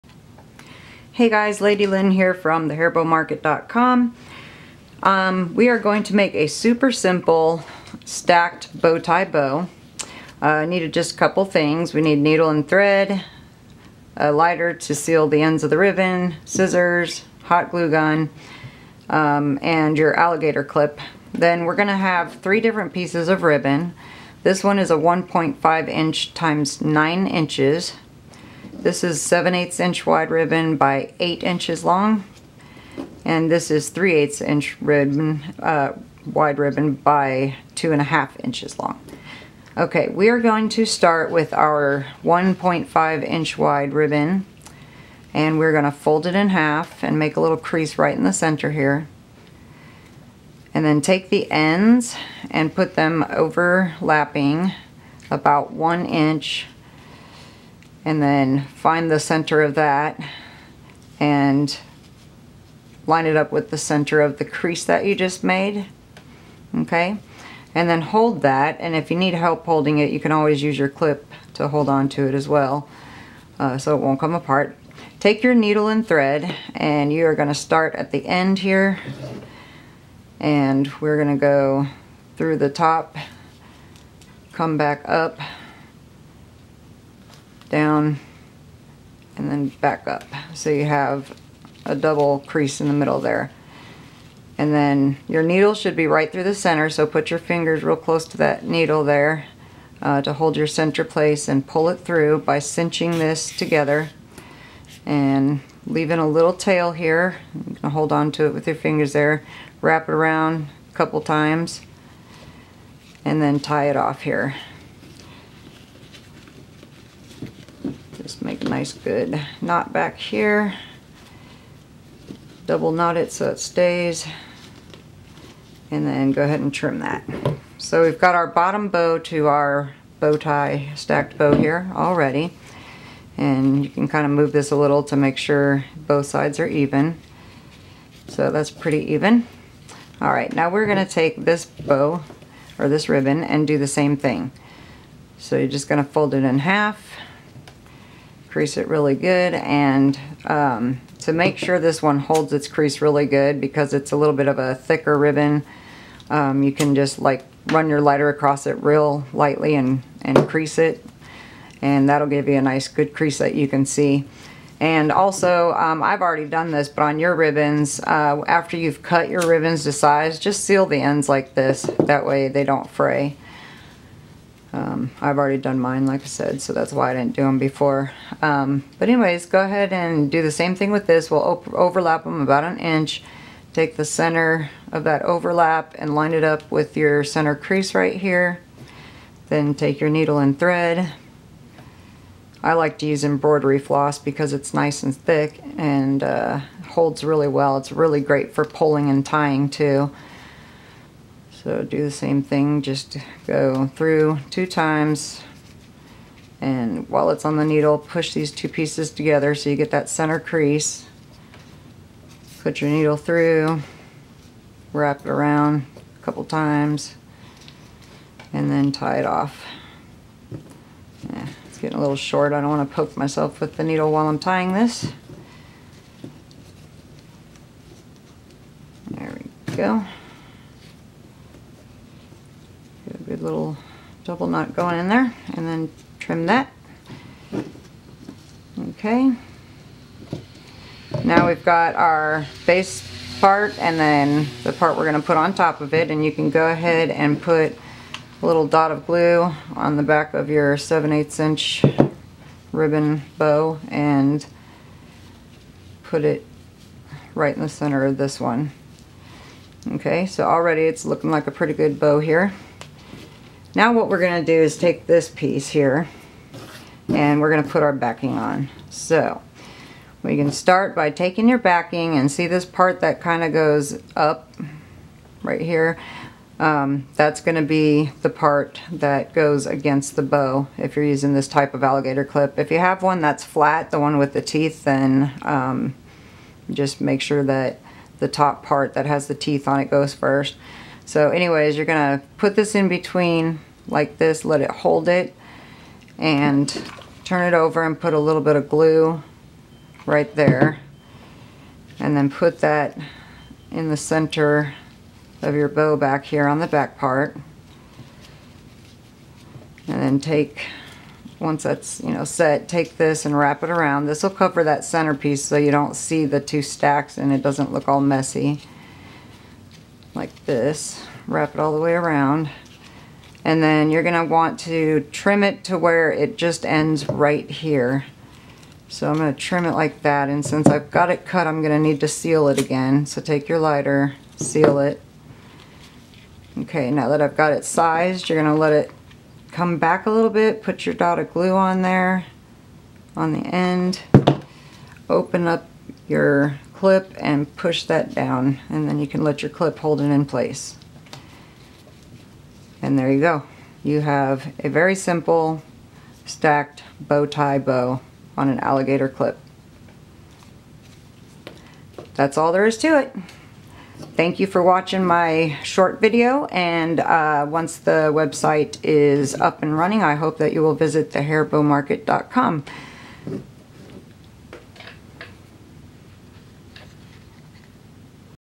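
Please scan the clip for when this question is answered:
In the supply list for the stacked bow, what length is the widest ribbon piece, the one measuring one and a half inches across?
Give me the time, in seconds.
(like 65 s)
26 s.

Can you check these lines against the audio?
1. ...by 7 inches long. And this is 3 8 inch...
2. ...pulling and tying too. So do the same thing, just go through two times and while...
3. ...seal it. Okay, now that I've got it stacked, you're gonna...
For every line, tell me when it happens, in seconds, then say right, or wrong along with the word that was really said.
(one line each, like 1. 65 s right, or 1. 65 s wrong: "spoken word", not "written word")
1. 30 s wrong: "8", not "7"
2. 198 s right
3. 334 s wrong: "sized", not "stacked".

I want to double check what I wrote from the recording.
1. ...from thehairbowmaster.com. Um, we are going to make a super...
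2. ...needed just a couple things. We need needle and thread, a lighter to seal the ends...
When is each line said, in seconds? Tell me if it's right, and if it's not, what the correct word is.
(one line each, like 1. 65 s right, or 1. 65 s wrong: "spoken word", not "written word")
1. 2 s right
2. 10 s right.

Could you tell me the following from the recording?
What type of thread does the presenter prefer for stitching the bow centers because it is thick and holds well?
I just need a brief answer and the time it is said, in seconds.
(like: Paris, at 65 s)
Embroidery floss, at 193 s.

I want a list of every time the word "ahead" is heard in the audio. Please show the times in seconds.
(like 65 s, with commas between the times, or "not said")
126 s, 179 s, 246 s.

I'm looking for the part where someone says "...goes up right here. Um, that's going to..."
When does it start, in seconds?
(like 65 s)
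273 s.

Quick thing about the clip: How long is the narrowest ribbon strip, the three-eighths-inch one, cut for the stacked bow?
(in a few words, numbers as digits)
2.5 inches.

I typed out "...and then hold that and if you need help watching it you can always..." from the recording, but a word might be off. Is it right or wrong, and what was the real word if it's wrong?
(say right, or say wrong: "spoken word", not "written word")
wrong: "holding", not "watching".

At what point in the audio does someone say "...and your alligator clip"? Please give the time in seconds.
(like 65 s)
19 s.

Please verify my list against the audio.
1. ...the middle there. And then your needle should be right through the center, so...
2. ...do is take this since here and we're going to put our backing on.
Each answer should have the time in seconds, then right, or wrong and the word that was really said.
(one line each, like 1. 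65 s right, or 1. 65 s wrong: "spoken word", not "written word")
1. 92 s right
2. 264 s wrong: "piece", not "since".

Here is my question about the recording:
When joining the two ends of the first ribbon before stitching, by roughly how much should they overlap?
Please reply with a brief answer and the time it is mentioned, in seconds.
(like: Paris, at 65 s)
1 inch, at 55 s.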